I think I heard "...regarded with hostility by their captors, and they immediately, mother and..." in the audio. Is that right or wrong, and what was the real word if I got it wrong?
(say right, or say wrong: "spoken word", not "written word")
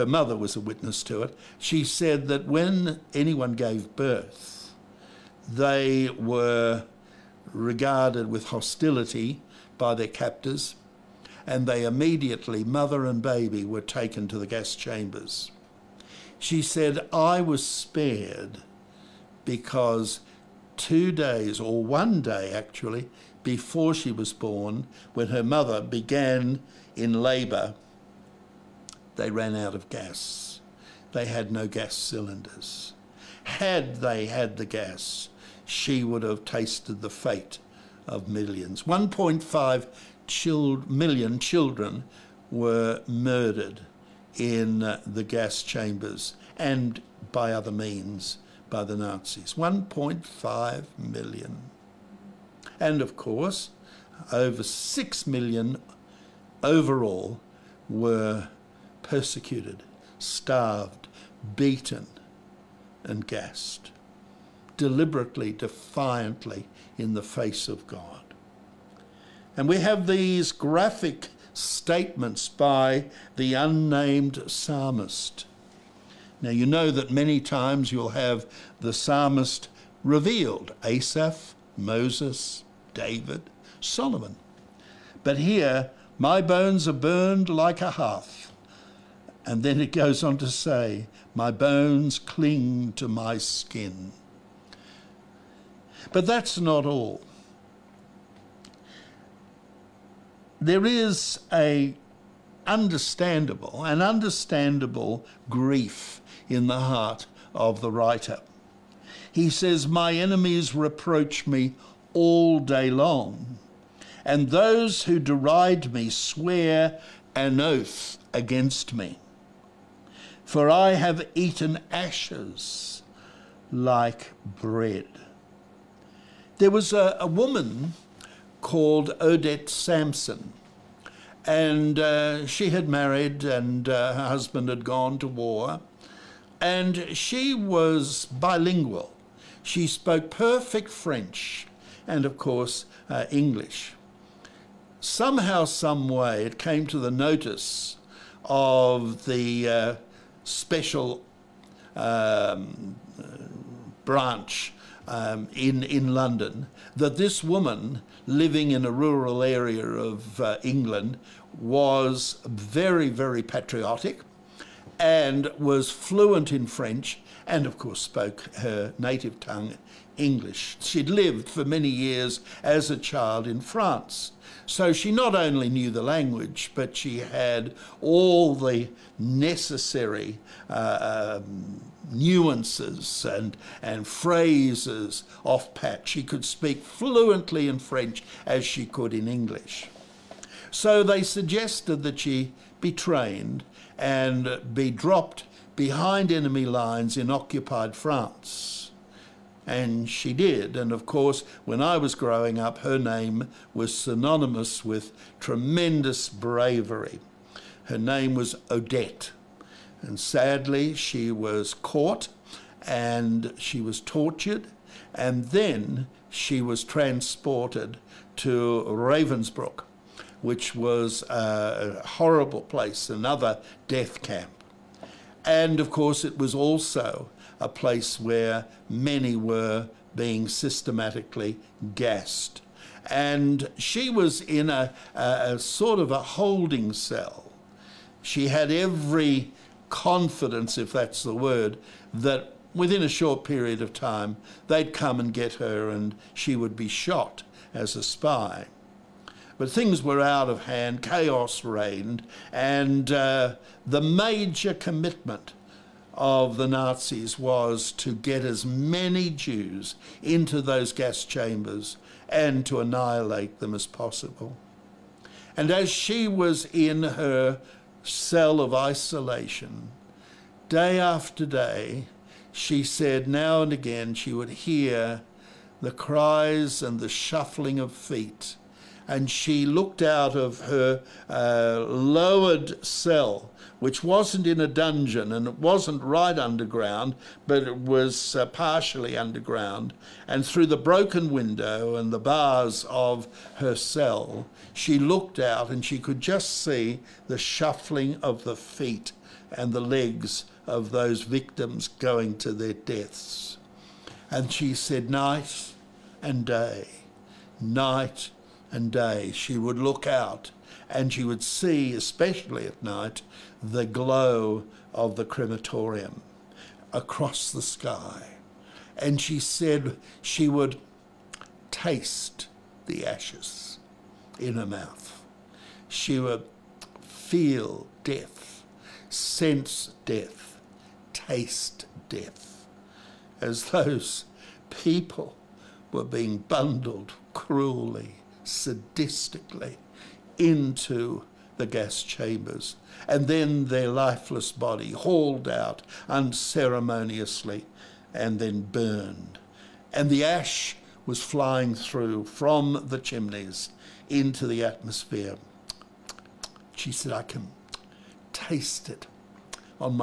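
right.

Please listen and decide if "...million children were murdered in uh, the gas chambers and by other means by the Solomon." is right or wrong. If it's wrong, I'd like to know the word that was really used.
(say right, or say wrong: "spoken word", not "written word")
wrong: "Nazis", not "Solomon".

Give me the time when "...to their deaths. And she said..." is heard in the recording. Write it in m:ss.
5:02.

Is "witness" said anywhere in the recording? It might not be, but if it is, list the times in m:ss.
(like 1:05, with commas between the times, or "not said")
0:00.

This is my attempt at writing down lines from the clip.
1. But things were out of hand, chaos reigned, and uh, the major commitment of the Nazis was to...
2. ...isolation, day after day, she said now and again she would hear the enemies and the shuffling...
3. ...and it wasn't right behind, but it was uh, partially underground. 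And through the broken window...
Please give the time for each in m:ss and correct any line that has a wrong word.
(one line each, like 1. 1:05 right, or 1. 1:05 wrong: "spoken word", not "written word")
1. 4:09 right
2. 4:28 wrong: "cries", not "enemies"
3. 4:45 wrong: "underground", not "behind".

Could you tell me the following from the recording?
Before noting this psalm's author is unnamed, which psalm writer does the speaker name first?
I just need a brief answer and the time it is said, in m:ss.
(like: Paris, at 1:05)
Asaph, at 1:20.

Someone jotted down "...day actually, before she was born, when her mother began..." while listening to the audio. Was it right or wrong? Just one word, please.
right.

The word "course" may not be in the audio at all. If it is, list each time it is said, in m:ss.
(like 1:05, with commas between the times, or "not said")
0:53, 2:22, 2:47, 3:21, 3:45.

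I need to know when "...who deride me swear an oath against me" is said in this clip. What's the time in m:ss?
1:55.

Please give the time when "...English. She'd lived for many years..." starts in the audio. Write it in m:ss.
2:50.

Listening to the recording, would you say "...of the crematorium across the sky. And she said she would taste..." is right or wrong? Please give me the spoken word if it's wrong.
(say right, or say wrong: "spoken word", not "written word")
right.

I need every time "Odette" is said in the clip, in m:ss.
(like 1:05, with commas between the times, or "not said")
2:09, 3:28.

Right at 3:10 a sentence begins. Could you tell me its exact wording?
So they suggested that she be trained and be dropped behind enemy lines in occupied France.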